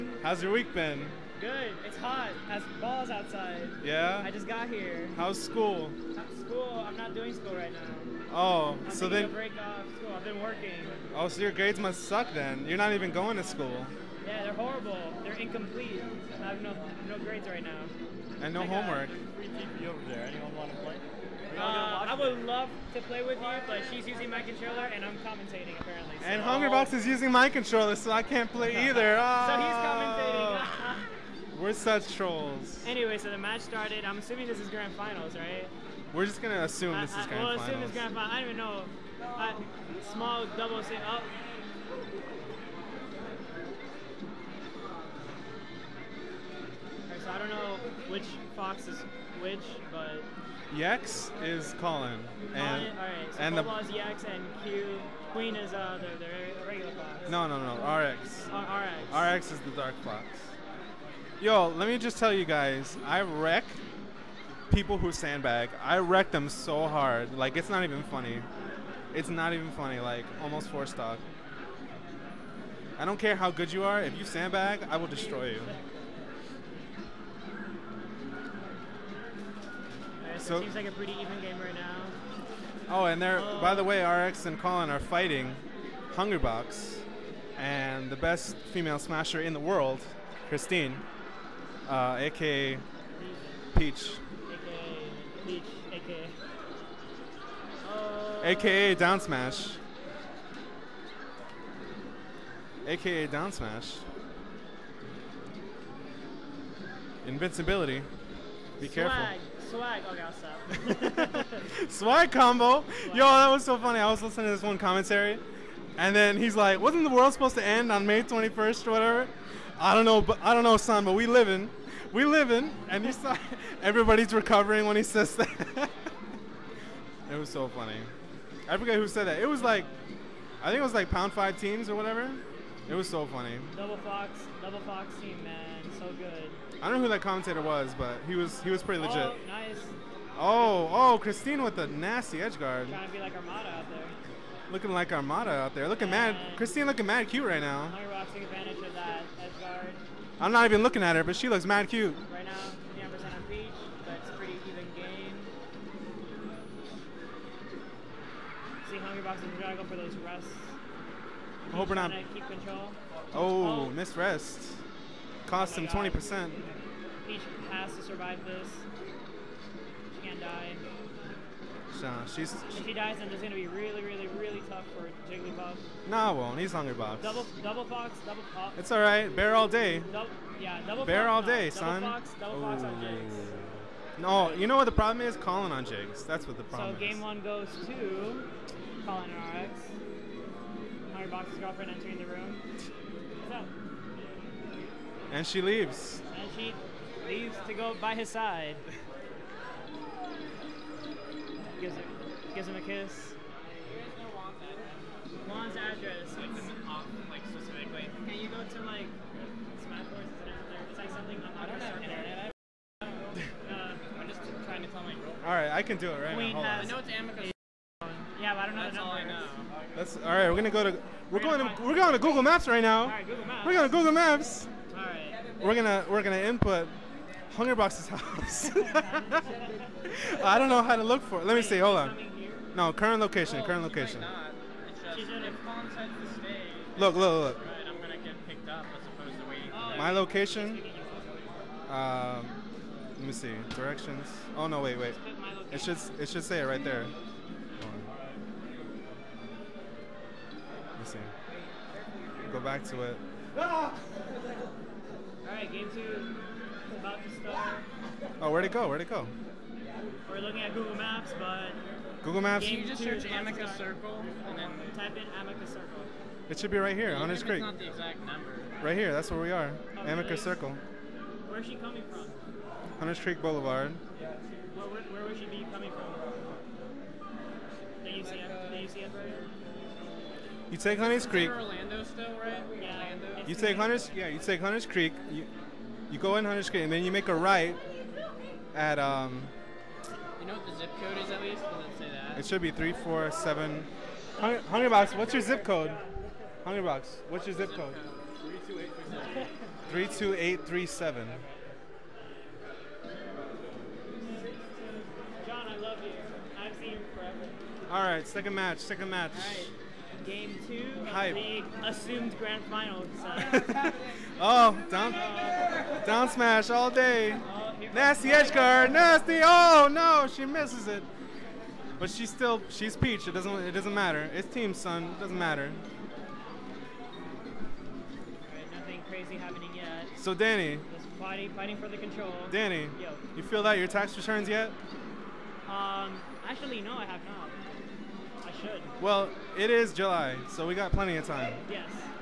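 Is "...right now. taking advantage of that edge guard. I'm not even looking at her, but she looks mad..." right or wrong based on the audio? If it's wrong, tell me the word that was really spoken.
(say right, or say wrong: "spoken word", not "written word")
right.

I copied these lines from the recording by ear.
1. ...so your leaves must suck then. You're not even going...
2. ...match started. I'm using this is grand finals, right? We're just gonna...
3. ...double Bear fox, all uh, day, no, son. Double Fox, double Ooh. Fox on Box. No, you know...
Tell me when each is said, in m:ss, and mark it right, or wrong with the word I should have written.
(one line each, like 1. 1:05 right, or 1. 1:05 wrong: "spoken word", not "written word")
1. 0:11 wrong: "grades", not "leaves"
2. 0:33 wrong: "assuming", not "using"
3. 3:00 wrong: "Jigs", not "Box".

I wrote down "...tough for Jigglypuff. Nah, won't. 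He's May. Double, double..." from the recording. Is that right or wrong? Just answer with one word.
wrong.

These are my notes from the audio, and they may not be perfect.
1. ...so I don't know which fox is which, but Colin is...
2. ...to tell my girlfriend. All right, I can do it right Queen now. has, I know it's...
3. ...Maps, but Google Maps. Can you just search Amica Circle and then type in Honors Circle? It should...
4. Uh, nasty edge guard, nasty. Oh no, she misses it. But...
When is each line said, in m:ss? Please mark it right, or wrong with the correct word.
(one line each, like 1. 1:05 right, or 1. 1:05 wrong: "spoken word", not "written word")
1. 0:47 wrong: "Yex", not "Colin"
2. 3:34 right
3. 4:20 wrong: "Amica", not "Honors"
4. 5:17 right.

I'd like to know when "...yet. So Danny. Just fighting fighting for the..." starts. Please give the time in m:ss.
5:29.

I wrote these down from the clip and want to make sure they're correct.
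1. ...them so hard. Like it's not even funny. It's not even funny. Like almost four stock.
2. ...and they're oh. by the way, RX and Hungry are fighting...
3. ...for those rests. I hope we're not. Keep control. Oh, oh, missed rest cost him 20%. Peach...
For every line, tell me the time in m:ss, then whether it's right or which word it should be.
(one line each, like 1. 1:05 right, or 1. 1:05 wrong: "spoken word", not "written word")
1. 1:06 right
2. 1:23 wrong: "Colin", not "Hungry"
3. 2:39 right.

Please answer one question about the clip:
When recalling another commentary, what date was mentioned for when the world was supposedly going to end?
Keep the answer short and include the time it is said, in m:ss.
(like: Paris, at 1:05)
May 21st, at 1:58.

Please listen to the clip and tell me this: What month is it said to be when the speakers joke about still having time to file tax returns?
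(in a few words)
July.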